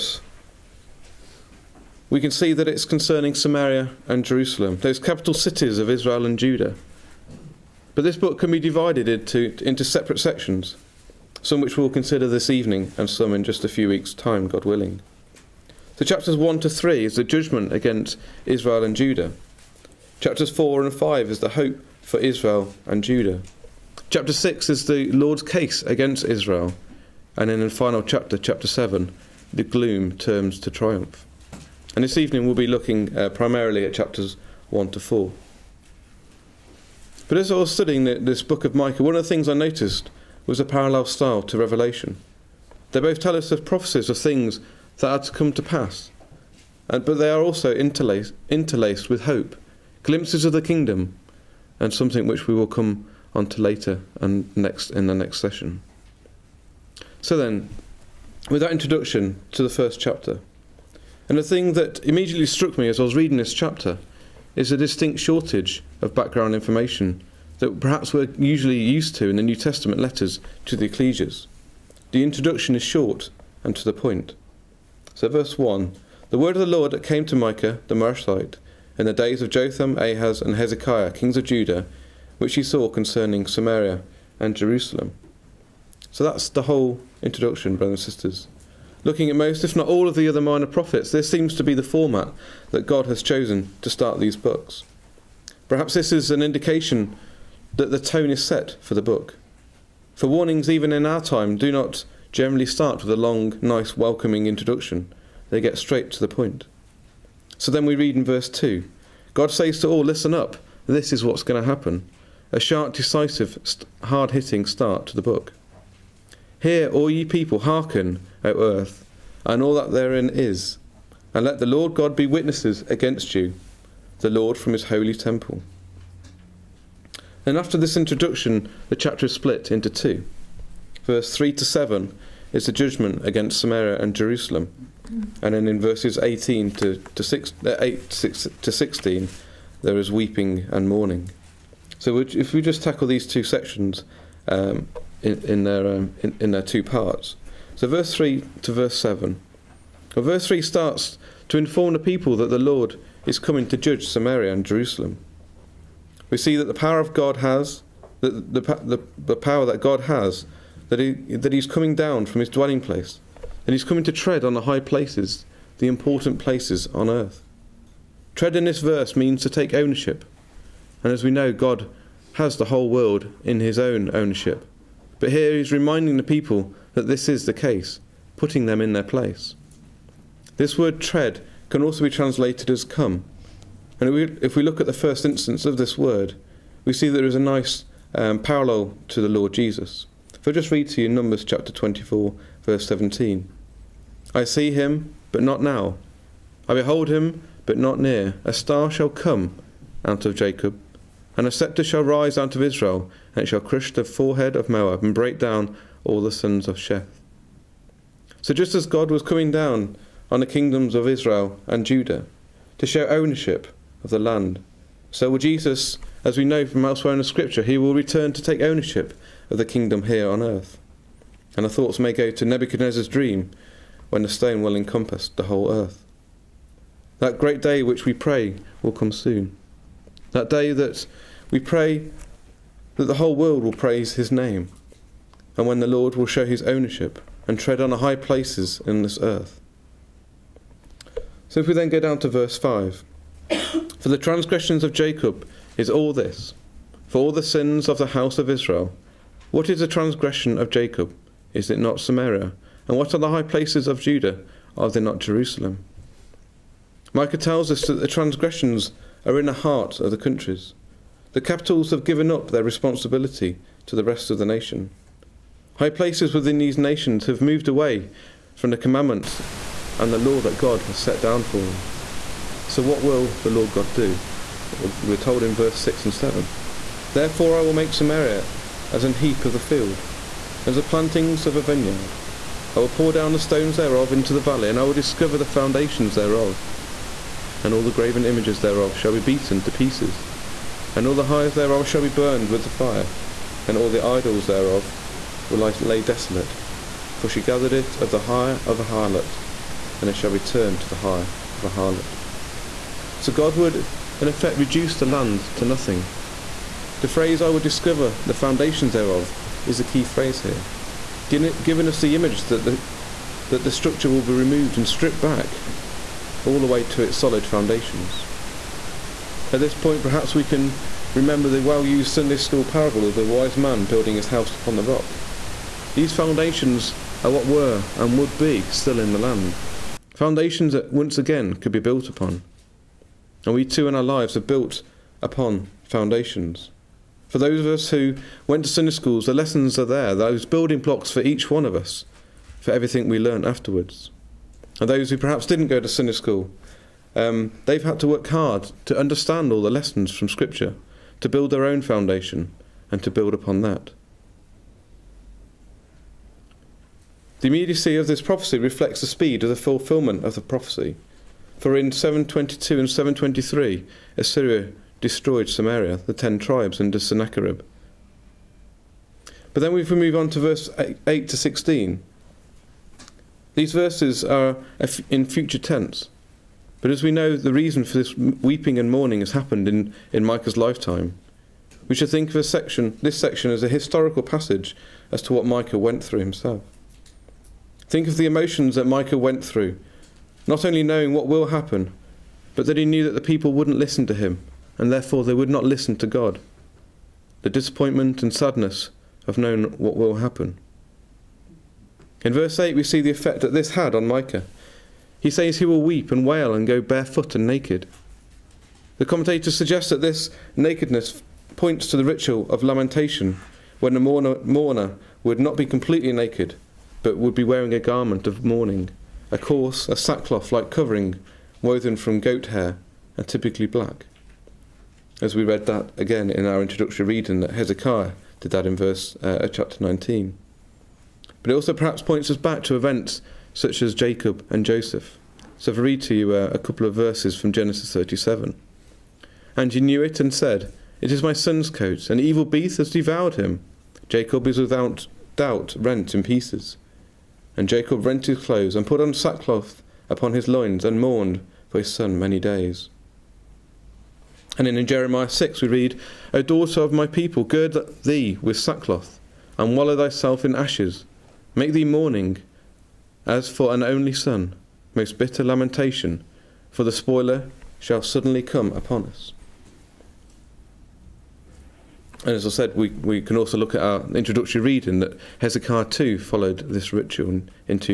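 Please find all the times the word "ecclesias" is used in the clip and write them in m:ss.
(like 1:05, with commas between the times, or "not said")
1:10.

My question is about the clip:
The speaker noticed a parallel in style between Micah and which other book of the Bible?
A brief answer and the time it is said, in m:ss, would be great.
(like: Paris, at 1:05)
Revelation, at 0:41.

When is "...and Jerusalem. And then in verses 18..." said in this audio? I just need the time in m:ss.
2:14.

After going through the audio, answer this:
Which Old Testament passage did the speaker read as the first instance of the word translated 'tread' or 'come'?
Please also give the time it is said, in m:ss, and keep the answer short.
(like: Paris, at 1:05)
Numbers 24:17, at 3:11.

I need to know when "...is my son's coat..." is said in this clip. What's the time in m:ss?
7:21.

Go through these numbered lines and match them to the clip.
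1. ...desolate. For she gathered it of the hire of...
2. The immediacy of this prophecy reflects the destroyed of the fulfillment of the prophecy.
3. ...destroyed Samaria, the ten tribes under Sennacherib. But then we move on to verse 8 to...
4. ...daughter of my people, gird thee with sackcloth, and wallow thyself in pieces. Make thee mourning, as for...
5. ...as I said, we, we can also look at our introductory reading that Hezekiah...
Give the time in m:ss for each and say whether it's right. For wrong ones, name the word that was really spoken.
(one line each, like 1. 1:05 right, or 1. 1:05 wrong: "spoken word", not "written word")
1. 4:56 right
2. 5:57 wrong: "speed", not "destroyed"
3. 6:05 right
4. 7:36 wrong: "ashes", not "pieces"
5. 7:52 right.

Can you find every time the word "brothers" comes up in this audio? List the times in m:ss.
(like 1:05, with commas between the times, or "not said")
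1:27.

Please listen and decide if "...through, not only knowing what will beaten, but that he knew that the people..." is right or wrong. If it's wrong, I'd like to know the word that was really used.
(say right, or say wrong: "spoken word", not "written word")
wrong: "happen", not "beaten".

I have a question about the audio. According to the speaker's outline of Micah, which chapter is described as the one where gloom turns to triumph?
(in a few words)
Chapter 7.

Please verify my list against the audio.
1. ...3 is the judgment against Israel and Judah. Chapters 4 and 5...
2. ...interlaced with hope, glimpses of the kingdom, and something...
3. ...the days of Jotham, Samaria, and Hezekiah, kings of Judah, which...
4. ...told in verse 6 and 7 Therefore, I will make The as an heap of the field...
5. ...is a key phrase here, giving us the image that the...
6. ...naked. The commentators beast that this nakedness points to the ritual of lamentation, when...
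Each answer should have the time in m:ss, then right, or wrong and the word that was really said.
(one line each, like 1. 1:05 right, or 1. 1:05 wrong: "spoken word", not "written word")
1. 0:16 right
2. 0:48 right
3. 1:19 wrong: "Ahaz", not "Samaria"
4. 4:35 wrong: "Samaria", not "The"
5. 5:09 right
6. 6:47 wrong: "suggest", not "beast".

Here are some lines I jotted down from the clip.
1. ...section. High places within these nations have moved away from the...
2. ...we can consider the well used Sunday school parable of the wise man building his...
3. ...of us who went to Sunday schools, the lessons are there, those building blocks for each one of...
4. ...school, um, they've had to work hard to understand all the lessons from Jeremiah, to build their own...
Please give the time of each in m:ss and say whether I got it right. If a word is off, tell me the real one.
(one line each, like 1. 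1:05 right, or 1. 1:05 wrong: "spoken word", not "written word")
1. 4:24 wrong: "nation", not "section"
2. 5:20 wrong: "remember", not "consider"
3. 5:37 right
4. 5:46 wrong: "Scripture", not "Jeremiah".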